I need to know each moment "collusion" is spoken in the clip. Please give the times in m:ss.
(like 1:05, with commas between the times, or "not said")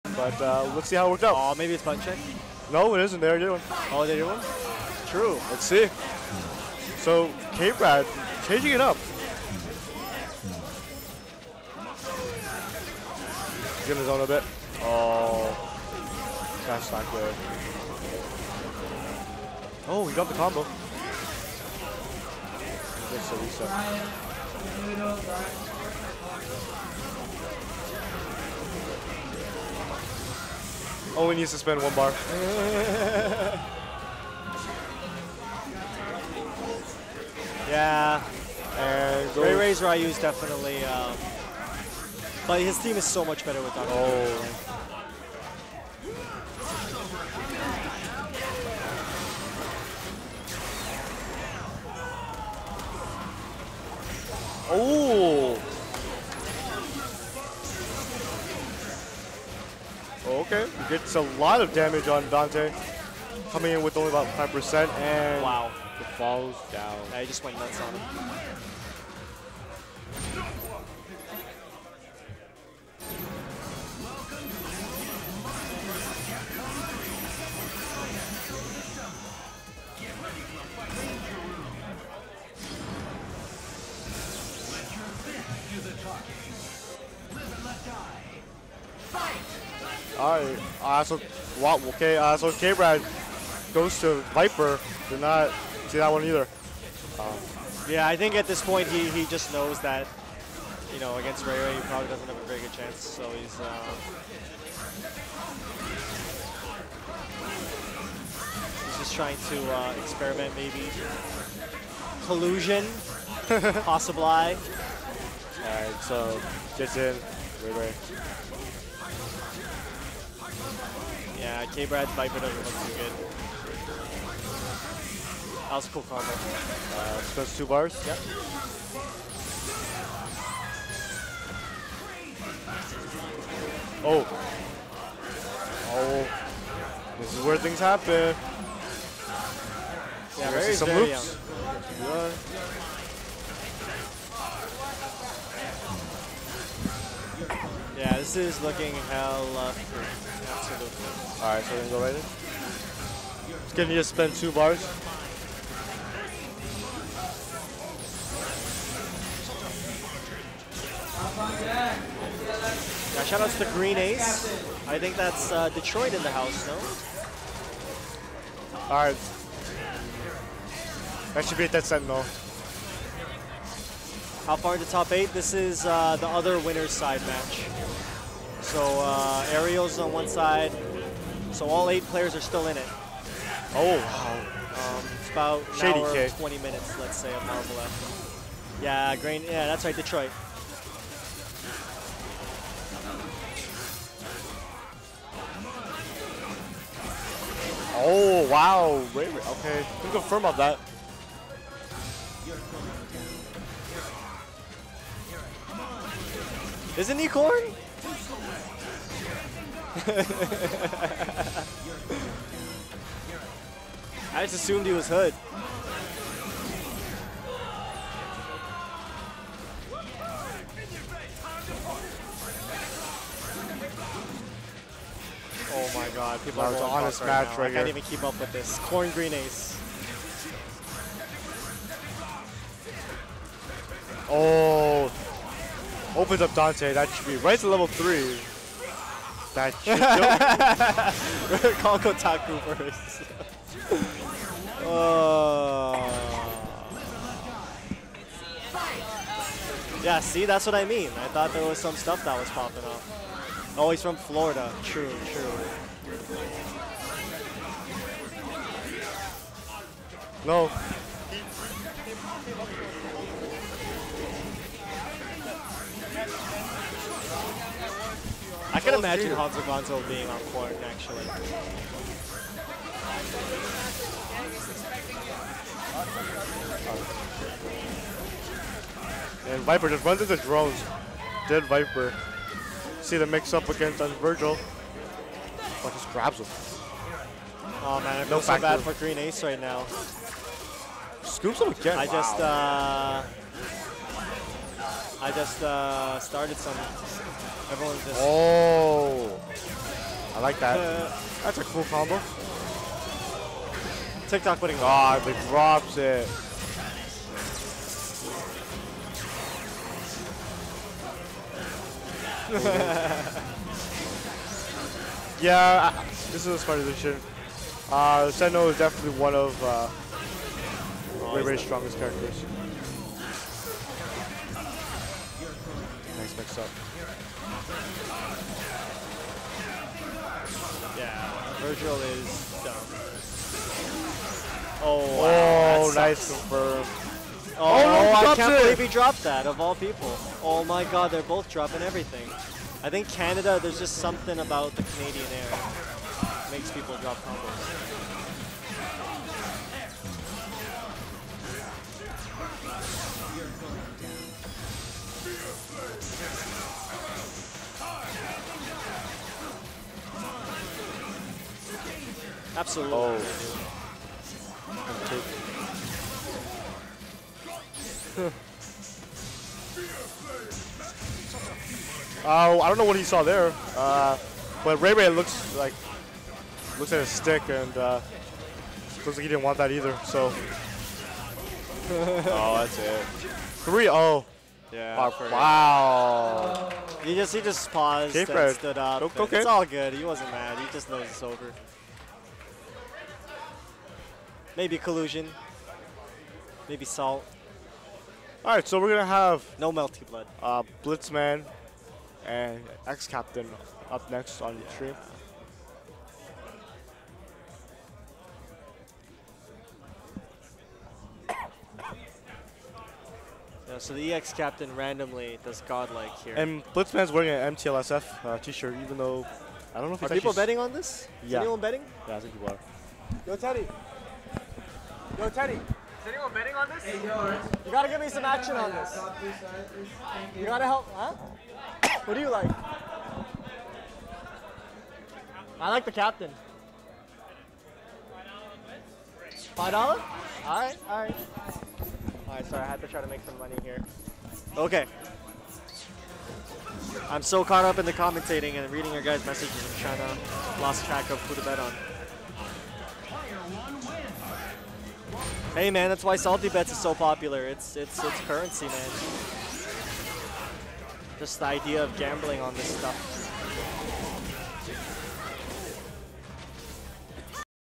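1:52, 6:34.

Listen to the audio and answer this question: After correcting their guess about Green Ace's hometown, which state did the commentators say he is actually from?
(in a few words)
Florida.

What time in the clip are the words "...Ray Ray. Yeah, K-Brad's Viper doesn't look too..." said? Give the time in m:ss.
1:57.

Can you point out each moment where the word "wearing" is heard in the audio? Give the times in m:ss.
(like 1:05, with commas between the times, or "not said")
6:57.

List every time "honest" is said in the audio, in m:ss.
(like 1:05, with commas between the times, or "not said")
3:47.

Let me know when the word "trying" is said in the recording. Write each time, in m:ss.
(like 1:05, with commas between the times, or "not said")
1:49, 7:29.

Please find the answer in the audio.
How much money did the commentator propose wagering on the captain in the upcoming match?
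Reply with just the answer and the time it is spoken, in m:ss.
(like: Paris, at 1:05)
$5, at 7:19.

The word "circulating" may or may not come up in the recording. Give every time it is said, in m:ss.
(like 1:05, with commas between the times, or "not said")
not said.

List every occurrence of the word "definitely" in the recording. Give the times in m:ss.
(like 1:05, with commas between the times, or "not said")
0:40, 5:18.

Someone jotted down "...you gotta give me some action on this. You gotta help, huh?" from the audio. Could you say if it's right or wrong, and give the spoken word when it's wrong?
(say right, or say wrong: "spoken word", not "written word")
right.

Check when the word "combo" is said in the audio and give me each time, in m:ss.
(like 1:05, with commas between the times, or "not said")
0:20, 2:06, 5:01, 5:47.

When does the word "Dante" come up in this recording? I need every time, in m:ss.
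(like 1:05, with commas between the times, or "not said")
1:02, 3:56.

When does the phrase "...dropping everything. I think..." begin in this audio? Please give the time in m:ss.
5:41.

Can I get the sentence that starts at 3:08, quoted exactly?
Yeah, Green, yeah, that's right, Detroit.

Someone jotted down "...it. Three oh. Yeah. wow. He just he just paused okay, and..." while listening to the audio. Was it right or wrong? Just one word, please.
right.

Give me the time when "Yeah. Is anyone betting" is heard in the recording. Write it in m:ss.
7:01.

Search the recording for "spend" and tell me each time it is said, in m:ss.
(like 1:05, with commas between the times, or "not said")
0:31, 2:34.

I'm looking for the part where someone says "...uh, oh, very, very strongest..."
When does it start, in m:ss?
5:19.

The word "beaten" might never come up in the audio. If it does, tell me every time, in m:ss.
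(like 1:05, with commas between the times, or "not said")
not said.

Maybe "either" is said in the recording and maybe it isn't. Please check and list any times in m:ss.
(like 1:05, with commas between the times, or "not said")
1:36, 6:19.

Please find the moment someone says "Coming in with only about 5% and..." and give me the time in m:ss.
1:03.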